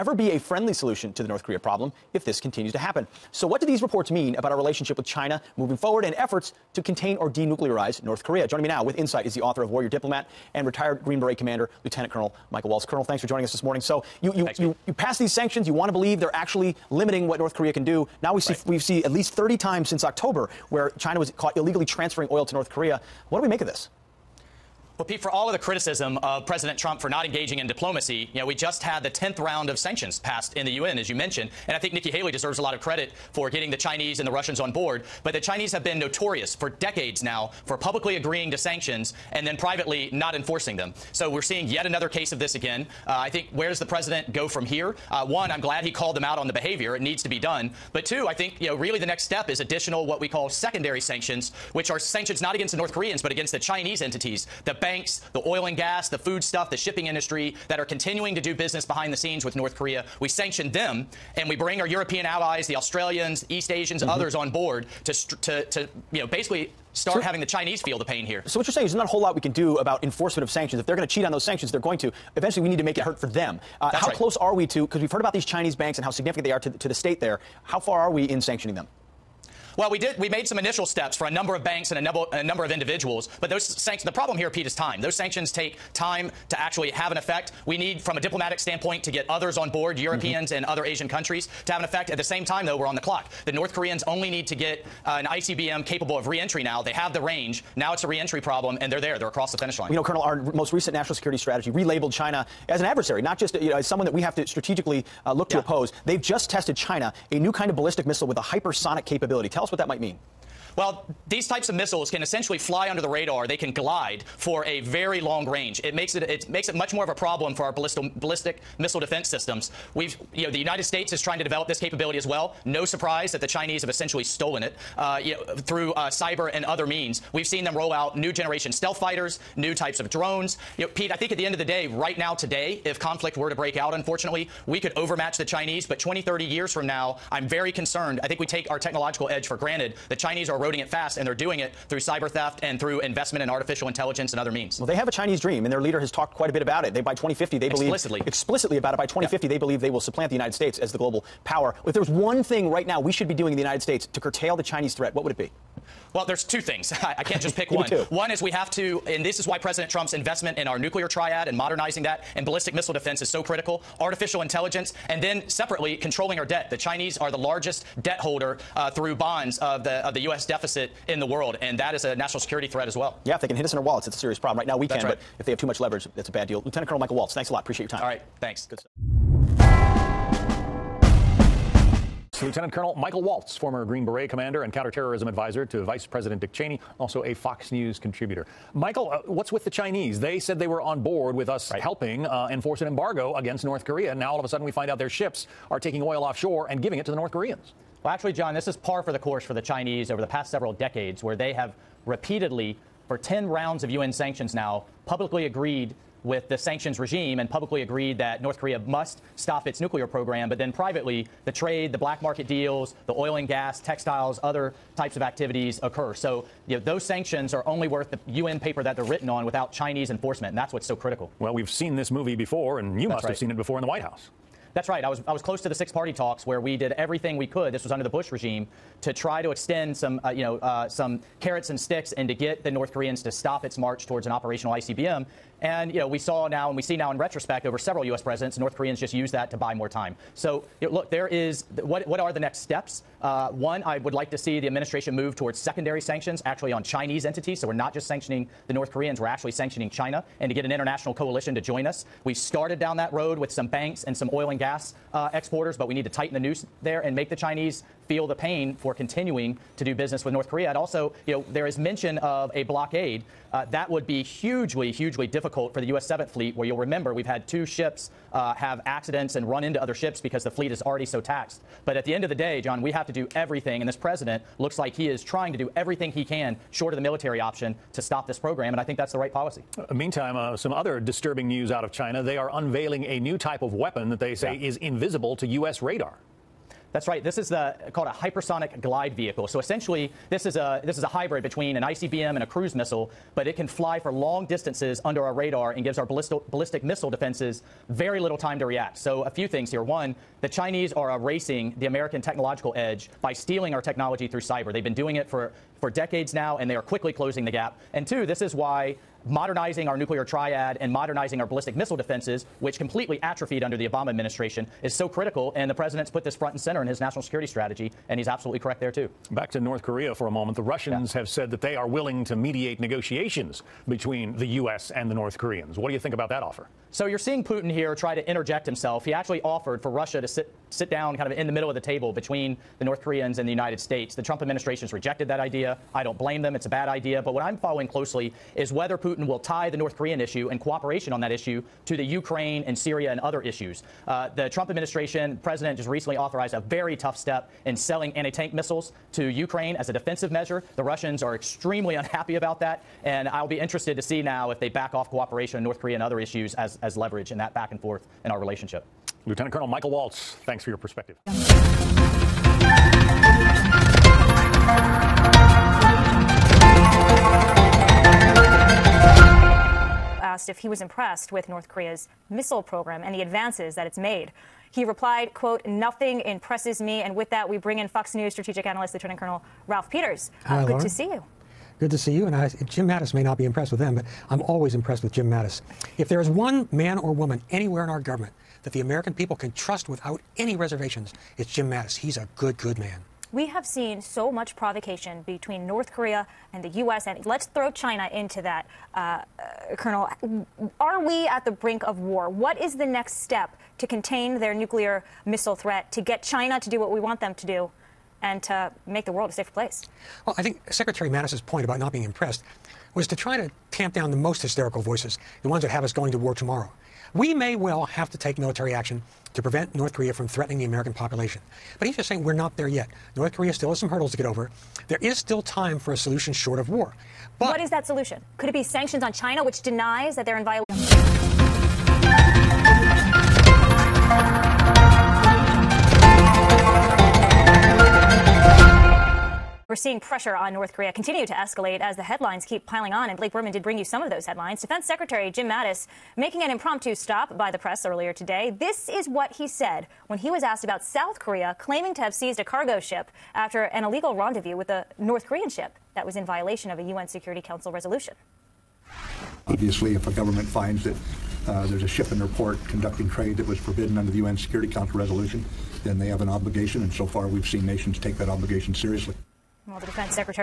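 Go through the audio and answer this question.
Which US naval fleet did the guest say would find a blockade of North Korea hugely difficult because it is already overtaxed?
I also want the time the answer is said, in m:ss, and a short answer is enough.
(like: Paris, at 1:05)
7th Fleet, at 4:26.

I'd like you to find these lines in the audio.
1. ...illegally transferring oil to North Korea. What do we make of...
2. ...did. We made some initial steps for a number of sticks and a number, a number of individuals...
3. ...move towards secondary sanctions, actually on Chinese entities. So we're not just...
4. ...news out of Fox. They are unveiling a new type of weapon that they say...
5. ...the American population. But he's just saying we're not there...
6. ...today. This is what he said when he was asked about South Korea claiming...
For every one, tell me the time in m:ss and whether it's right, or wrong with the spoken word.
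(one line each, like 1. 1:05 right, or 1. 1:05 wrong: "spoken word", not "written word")
1. 0:21 right
2. 1:19 wrong: "banks", not "sticks"
3. 4:05 right
4. 4:41 wrong: "China", not "Fox"
5. 7:00 right
6. 7:28 right.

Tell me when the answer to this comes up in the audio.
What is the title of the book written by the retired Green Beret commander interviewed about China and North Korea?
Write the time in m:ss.
0:09.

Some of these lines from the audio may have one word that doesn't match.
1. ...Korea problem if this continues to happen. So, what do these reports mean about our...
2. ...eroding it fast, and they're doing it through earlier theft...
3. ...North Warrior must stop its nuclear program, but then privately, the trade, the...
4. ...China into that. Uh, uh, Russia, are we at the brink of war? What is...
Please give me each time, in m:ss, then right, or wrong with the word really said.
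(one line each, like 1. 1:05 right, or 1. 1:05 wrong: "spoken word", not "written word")
1. 0:01 right
2. 2:20 wrong: "cyber", not "earlier"
3. 3:28 wrong: "Korea", not "Warrior"
4. 6:37 wrong: "Colonel", not "Russia".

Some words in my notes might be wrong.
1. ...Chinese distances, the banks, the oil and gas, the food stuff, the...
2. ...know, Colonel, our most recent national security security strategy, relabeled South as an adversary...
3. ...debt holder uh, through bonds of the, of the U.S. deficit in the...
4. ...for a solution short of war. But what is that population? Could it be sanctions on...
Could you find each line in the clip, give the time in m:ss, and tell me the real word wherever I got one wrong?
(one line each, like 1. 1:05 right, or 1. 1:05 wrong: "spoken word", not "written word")
1. 0:53 wrong: "entities", not "distances"
2. 1:39 wrong: "China", not "South"
3. 2:48 right
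4. 7:05 wrong: "solution", not "population".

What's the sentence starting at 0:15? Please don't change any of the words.
You want to believe they're actually limiting what North Korea can do.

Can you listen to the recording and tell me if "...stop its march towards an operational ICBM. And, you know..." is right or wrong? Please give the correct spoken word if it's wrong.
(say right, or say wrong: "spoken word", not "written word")
right.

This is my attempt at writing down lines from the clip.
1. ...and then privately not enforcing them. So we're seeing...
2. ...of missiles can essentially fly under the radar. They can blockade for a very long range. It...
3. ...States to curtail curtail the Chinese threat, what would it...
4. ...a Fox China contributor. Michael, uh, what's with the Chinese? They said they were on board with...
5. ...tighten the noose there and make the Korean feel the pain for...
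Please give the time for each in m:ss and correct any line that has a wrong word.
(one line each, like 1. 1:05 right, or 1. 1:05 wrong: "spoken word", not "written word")
1. 0:39 right
2. 1:51 wrong: "glide", not "blockade"
3. 2:33 right
4. 3:07 wrong: "News", not "China"
5. 4:16 wrong: "Chinese", not "Korean".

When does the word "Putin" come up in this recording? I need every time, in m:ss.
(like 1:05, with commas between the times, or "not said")
5:27, 5:38.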